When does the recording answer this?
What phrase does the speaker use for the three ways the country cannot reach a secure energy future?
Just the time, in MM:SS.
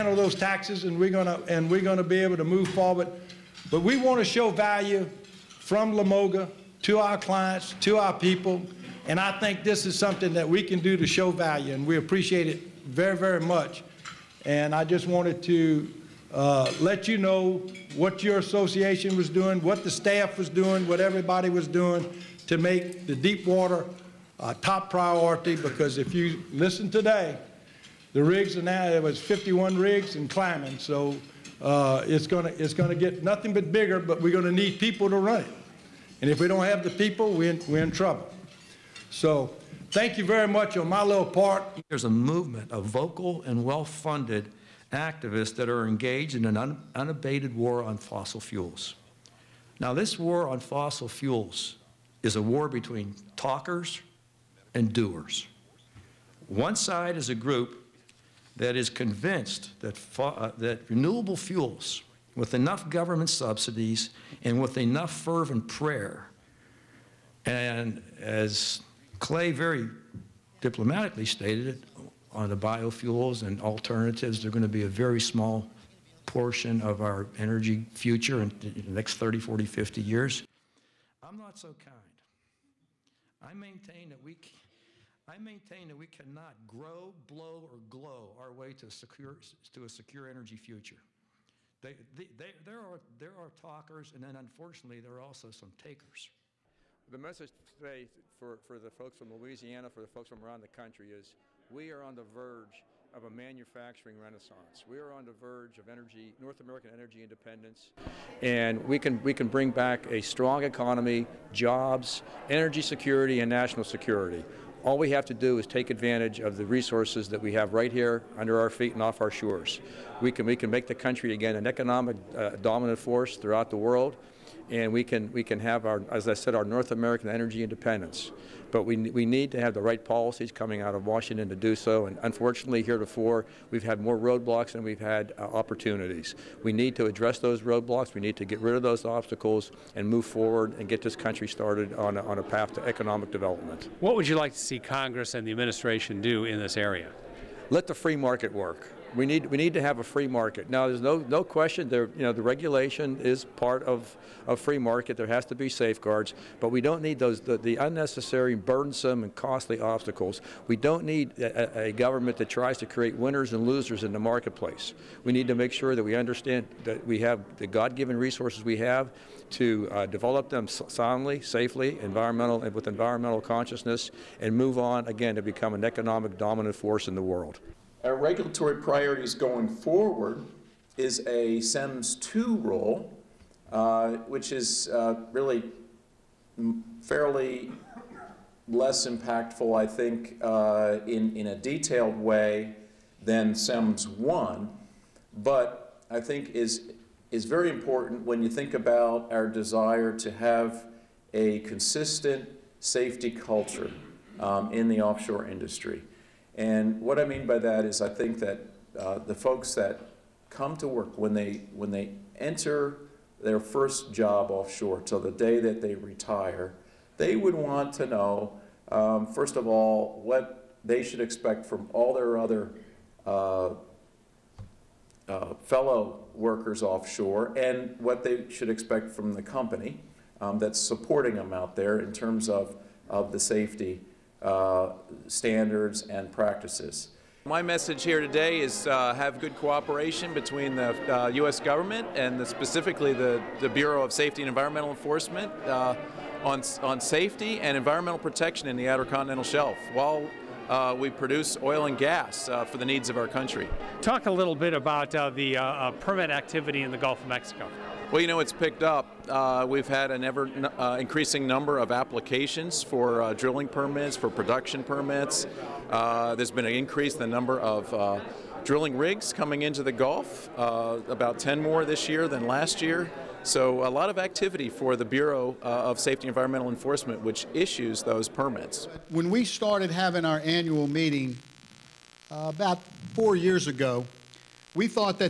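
01:26.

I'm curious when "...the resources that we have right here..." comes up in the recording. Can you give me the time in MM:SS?
01:56.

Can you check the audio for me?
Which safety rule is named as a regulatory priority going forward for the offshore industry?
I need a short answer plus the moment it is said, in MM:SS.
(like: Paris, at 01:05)
SEMS 2, at 03:01.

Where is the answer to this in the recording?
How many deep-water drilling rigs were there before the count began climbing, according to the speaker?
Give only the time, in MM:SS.
00:29.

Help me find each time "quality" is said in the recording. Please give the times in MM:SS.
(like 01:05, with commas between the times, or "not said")
not said.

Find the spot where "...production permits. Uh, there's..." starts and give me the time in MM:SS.
04:24.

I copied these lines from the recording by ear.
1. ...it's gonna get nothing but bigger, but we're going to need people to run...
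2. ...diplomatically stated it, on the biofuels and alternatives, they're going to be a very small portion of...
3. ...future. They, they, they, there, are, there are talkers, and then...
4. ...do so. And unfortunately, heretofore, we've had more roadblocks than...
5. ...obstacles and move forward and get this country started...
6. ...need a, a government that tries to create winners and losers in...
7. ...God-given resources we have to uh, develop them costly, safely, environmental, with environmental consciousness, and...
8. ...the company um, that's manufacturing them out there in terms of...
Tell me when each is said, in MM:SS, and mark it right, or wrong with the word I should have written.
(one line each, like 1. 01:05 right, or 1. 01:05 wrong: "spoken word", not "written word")
1. 00:32 right
2. 01:10 right
3. 01:30 right
4. 02:11 right
5. 02:19 right
6. 02:41 right
7. 02:47 wrong: "soundly", not "costly"
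8. 03:49 wrong: "supporting", not "manufacturing".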